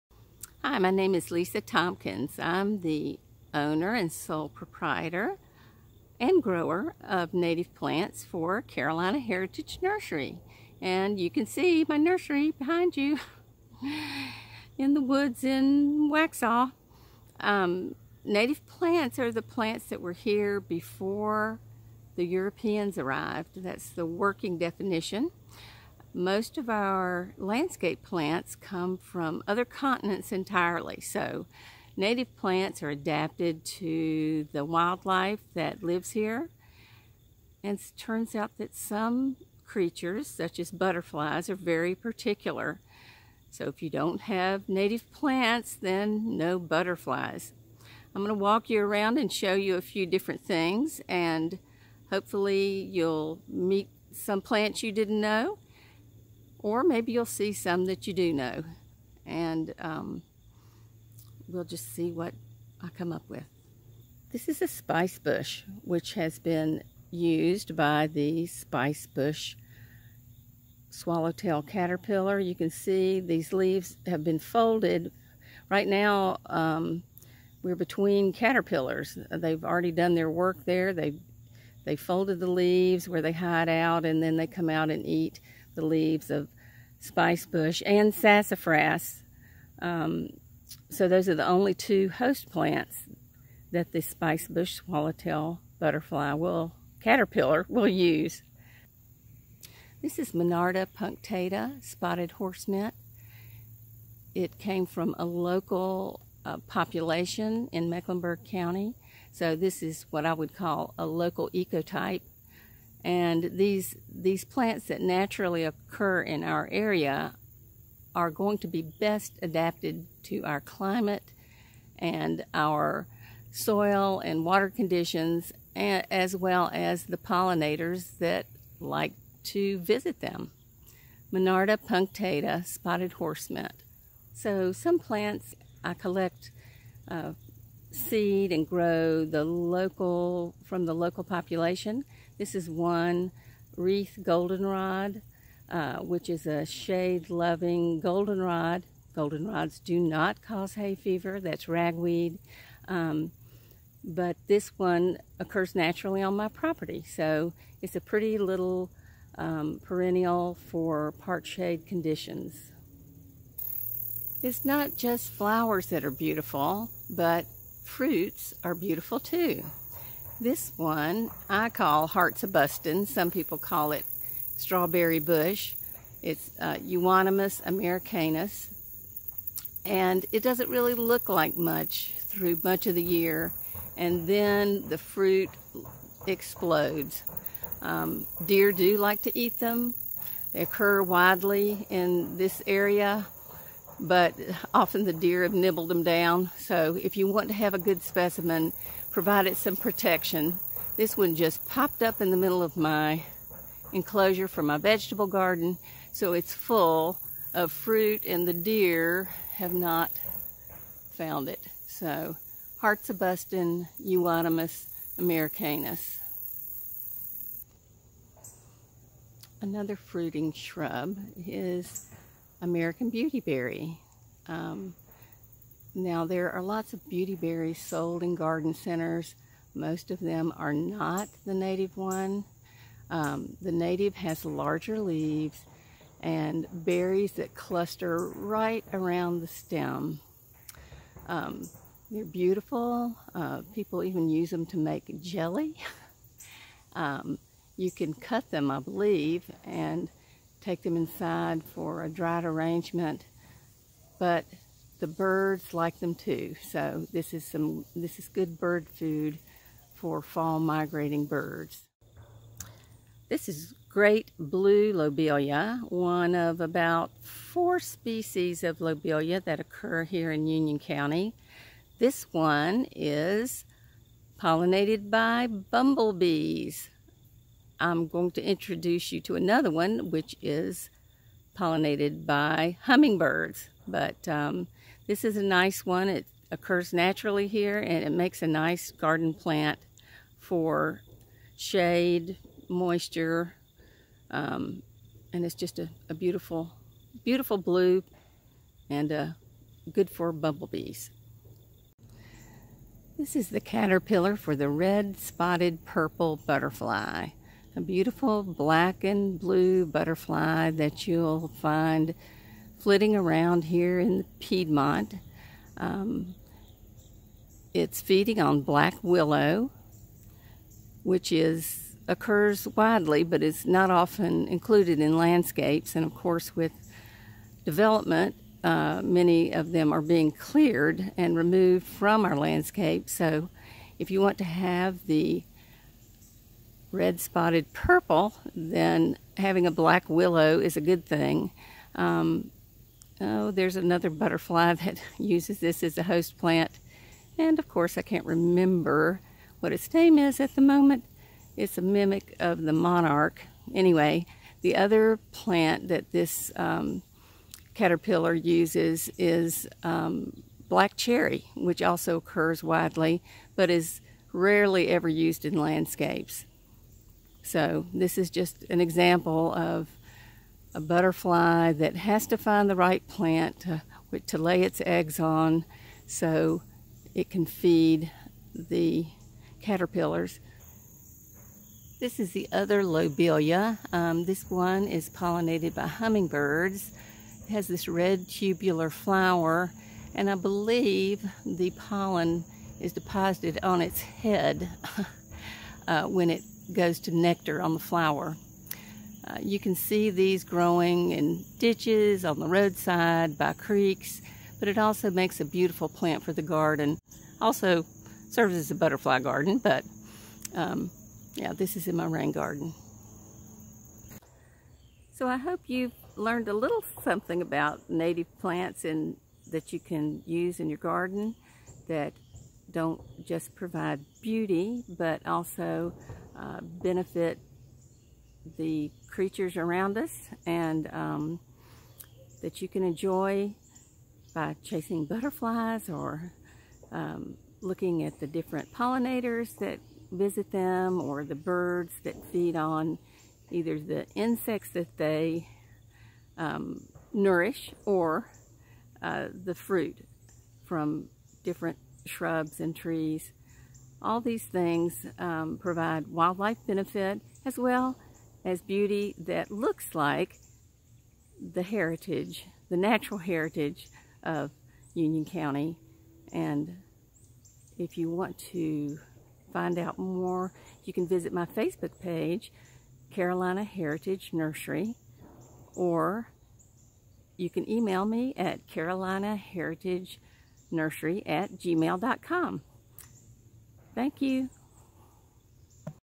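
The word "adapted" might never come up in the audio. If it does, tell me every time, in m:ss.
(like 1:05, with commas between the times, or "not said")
0:32, 1:59.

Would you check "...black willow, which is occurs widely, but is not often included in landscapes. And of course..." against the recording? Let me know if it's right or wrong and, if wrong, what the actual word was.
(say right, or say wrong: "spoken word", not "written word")
right.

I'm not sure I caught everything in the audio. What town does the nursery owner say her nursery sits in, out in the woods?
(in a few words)
Waxhaw.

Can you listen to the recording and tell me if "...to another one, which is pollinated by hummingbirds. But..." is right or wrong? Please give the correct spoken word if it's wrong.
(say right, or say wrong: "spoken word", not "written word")
right.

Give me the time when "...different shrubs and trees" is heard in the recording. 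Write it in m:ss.
7:31.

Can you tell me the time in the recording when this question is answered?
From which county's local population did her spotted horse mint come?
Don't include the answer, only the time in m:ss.
1:47.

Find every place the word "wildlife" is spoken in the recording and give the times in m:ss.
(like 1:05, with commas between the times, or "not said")
0:34, 7:36.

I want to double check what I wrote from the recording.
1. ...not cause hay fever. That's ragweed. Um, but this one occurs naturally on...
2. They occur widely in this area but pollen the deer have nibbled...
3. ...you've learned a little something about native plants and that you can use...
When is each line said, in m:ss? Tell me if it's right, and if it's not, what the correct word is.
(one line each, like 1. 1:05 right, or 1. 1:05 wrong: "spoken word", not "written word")
1. 2:29 right
2. 3:10 wrong: "often", not "pollen"
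3. 6:55 right.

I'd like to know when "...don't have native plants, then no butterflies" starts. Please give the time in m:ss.
0:43.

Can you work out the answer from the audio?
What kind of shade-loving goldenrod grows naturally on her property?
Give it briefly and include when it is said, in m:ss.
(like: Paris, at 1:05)
Wreath goldenrod, at 2:23.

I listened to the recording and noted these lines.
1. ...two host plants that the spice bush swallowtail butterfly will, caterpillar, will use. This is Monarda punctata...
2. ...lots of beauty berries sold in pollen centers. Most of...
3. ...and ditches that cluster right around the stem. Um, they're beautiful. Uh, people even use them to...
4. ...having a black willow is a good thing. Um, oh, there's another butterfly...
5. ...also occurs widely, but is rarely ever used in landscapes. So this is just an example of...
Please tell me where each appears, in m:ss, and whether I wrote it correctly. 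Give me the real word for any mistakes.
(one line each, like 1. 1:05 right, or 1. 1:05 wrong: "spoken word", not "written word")
1. 1:31 right
2. 3:46 wrong: "garden", not "pollen"
3. 3:56 wrong: "berries", not "ditches"
4. 5:39 right
5. 6:01 right.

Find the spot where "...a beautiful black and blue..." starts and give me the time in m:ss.
5:07.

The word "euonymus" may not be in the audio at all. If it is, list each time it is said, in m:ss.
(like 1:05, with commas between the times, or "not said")
2:56, 3:33.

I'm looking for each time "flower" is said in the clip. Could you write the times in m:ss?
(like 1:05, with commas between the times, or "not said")
2:45, 6:28, 6:37.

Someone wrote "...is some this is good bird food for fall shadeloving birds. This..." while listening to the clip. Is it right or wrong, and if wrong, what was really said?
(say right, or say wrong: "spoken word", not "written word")
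wrong: "migrating", not "shadeloving".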